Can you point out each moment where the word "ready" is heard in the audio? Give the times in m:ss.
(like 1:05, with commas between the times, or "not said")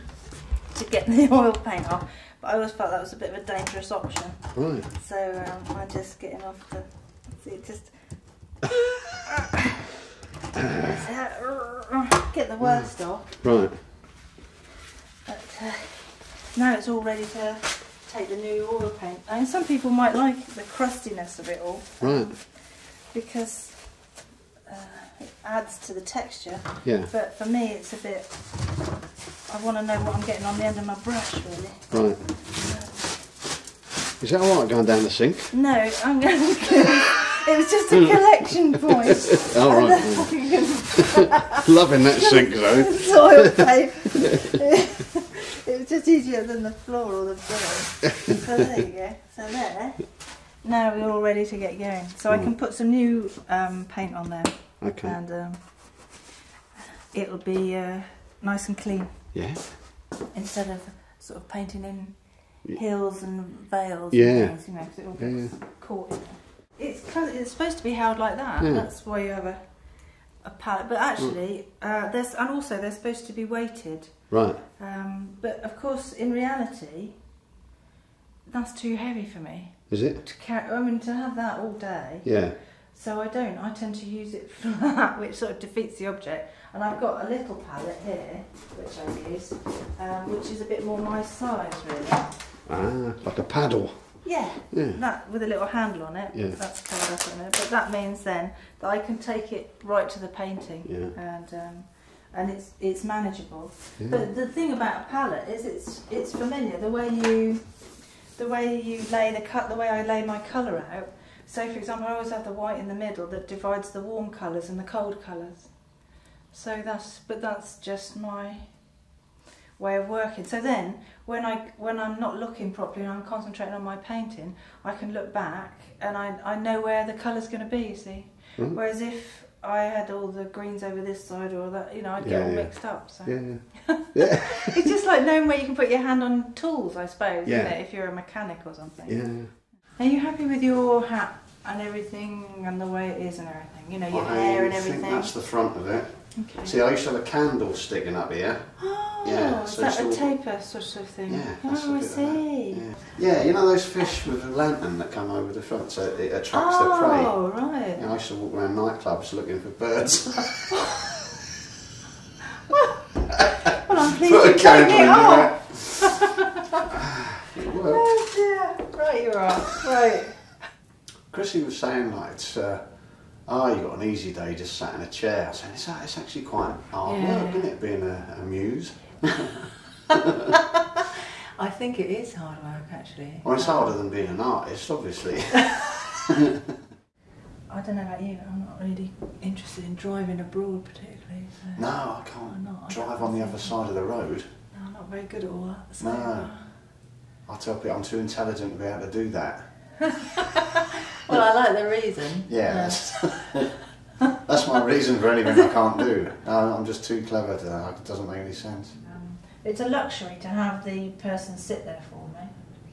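0:17, 0:51.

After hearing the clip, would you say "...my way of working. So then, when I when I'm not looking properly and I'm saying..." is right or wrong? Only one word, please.
wrong.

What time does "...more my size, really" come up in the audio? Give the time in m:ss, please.
1:30.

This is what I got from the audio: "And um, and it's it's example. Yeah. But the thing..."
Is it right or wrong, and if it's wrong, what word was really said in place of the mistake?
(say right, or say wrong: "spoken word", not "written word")
wrong: "manageable", not "example".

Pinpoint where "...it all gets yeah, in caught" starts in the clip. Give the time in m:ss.
1:04.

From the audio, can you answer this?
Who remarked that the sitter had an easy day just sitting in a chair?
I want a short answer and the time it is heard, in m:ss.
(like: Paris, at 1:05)
Chrissy, at 2:51.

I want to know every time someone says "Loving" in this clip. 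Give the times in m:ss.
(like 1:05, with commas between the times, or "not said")
0:41.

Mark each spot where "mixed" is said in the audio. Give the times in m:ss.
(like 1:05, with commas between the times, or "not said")
2:12.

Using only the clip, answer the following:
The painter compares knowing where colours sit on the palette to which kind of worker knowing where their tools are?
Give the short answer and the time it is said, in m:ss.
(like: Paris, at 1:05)
Mechanic, at 2:18.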